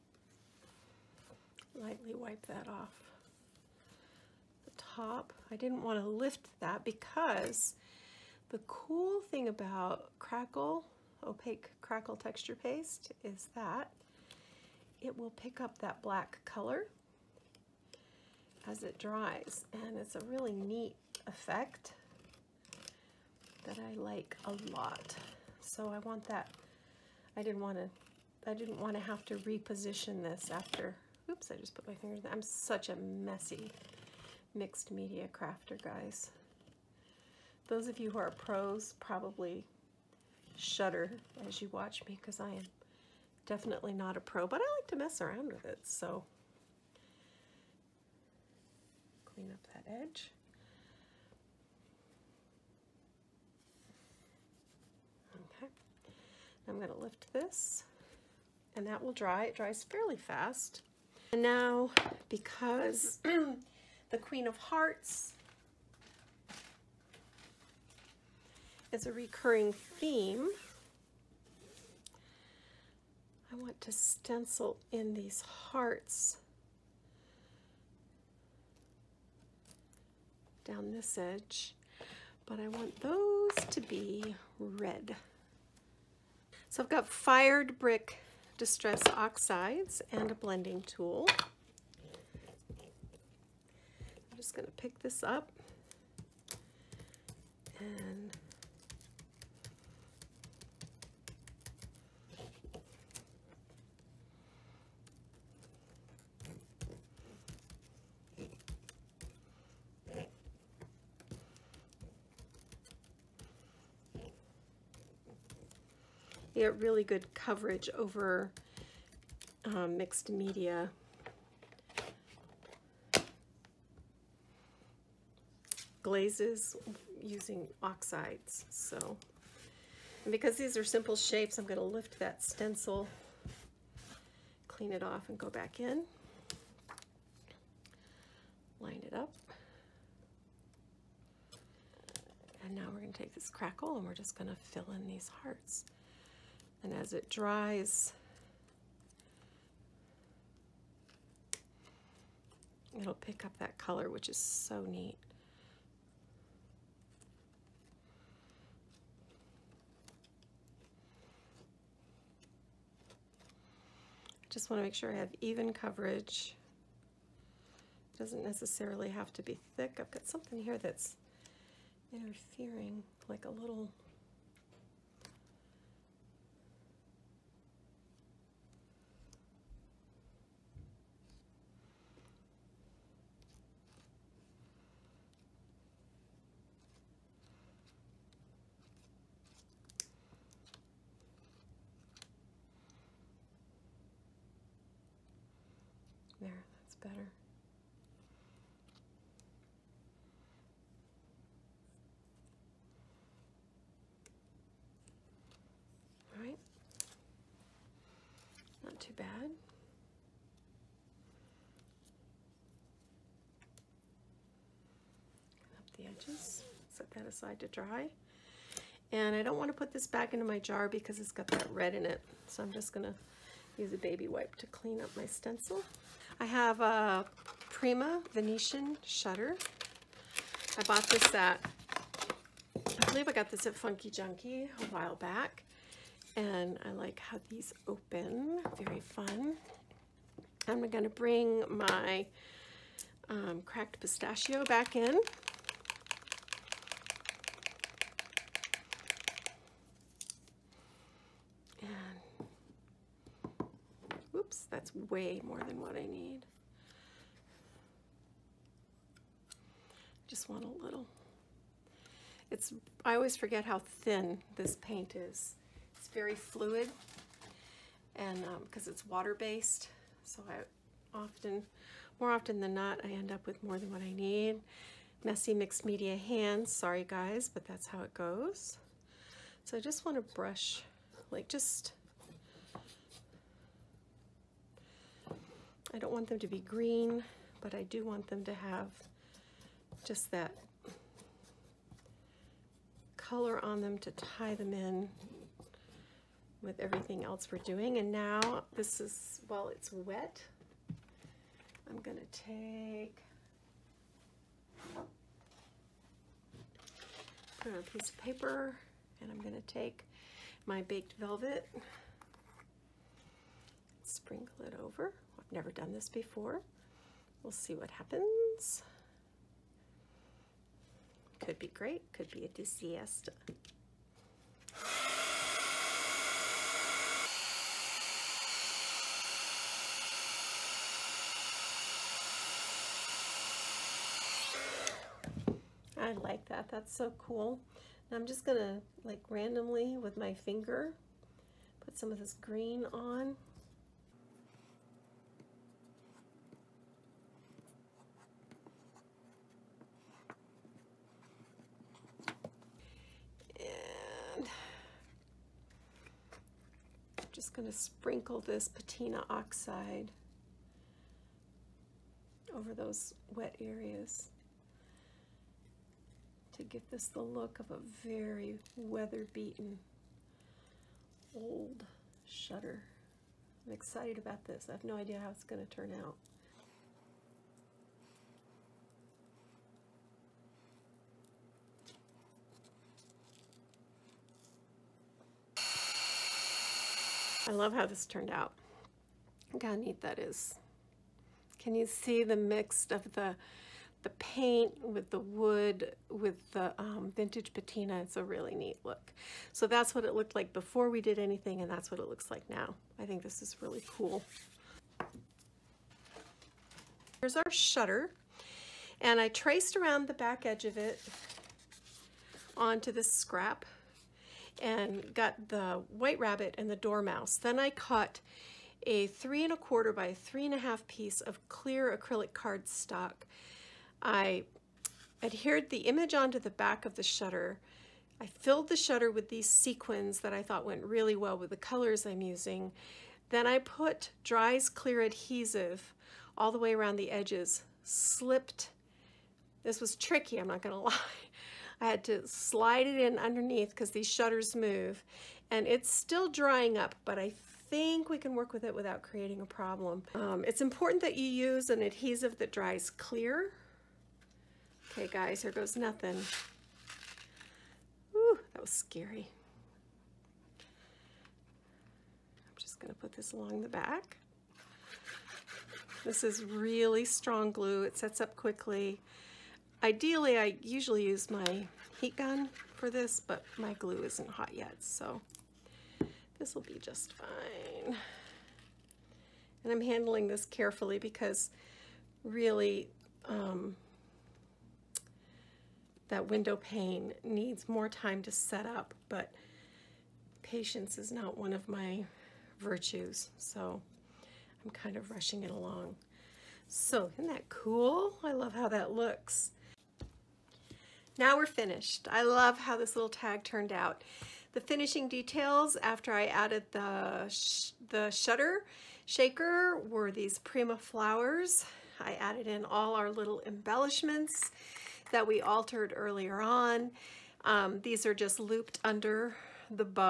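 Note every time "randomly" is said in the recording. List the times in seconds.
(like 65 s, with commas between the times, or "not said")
339 s.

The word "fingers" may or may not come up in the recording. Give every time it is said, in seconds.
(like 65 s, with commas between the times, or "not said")
31 s, 340 s.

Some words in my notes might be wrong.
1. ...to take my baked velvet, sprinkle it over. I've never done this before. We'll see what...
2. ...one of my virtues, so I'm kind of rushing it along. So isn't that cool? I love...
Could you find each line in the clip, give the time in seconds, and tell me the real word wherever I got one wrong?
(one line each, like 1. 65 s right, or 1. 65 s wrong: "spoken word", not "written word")
1. 309 s right
2. 491 s right.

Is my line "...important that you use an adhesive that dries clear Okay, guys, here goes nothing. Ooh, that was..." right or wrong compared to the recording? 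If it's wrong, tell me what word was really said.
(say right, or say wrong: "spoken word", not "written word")
right.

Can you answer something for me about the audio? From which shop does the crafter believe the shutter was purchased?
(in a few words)
Funkie Junkie.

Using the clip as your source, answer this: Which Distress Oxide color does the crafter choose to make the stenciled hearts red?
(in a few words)
Fired Brick.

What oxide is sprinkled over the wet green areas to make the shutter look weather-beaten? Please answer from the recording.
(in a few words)
patina oxide.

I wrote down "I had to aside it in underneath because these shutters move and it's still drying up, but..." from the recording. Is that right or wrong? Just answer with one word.
wrong.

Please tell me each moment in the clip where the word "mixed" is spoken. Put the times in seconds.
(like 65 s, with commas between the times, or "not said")
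34 s, 119 s, 275 s.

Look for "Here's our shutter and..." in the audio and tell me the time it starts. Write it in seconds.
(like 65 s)
407 s.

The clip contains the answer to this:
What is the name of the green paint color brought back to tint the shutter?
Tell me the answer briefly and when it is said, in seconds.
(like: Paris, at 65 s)
cracked pistachio, at 243 s.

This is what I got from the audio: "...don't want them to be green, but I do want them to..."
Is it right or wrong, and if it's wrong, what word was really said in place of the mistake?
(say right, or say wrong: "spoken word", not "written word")
right.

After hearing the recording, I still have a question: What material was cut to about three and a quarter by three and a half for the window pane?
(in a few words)
clear acrylic cardstock.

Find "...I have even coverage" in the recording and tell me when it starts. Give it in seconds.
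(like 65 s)
165 s.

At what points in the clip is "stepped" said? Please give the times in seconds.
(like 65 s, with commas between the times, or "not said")
not said.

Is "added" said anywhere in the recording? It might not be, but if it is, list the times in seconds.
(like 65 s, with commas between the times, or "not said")
506 s, 512 s.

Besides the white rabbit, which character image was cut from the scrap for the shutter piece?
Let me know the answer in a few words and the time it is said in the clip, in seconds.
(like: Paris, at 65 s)
dormouse, at 416 s.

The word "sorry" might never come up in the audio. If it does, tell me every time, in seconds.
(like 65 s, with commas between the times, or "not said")
276 s.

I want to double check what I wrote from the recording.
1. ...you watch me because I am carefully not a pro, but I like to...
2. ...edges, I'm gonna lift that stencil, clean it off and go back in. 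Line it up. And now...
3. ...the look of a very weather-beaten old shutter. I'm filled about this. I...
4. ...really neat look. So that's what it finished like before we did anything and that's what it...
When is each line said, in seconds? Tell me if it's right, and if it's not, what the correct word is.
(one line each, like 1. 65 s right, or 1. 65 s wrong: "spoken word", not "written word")
1. 41 s wrong: "definitely", not "carefully"
2. 131 s wrong: "shapes", not "edges"
3. 367 s wrong: "excited", not "filled"
4. 398 s wrong: "looked", not "finished".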